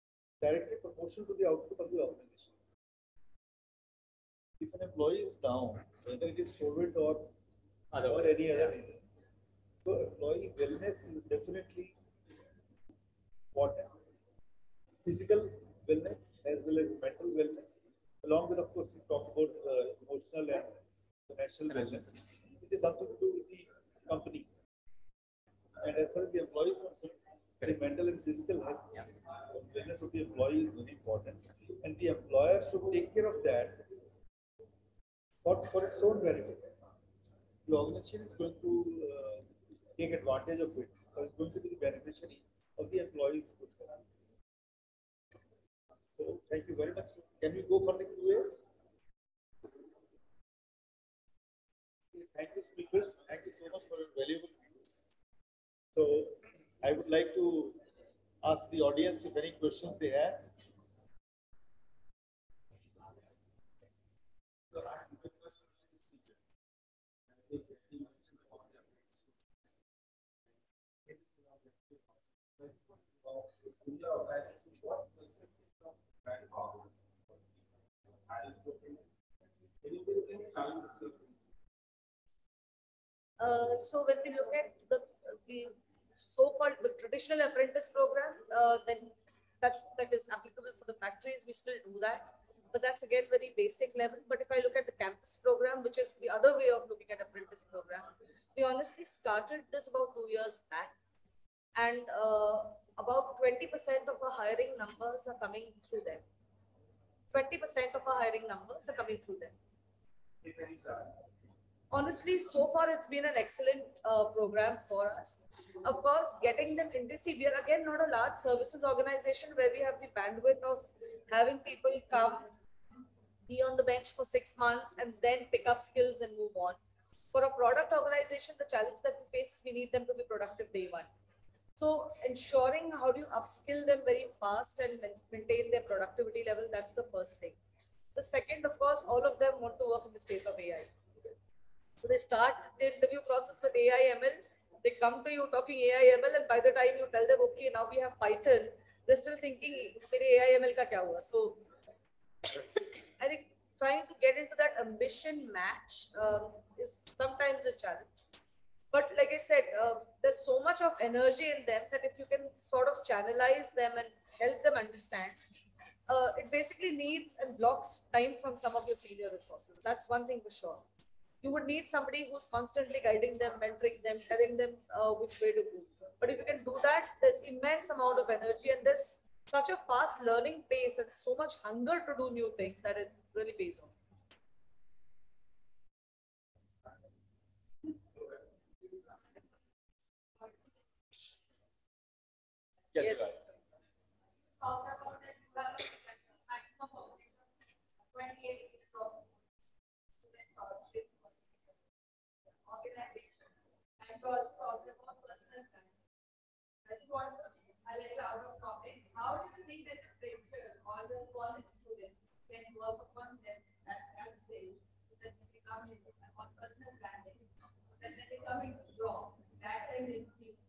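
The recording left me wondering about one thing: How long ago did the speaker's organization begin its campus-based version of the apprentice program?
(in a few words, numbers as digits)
2 years.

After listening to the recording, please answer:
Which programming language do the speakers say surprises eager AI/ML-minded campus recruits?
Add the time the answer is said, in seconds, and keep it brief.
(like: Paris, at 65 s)
Python, at 148 s.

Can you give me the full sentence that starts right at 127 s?
For a product organization, the challenge that we face is we need them to be productive day one.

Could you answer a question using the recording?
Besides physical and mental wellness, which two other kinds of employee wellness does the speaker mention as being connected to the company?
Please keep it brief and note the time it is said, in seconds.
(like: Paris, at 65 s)
emotional and financial, at 20 s.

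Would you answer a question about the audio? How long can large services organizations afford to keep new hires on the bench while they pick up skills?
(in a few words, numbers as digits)
6 months.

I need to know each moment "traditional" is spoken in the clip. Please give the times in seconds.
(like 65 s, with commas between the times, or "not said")
86 s.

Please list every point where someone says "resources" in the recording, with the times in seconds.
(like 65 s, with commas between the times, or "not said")
169 s.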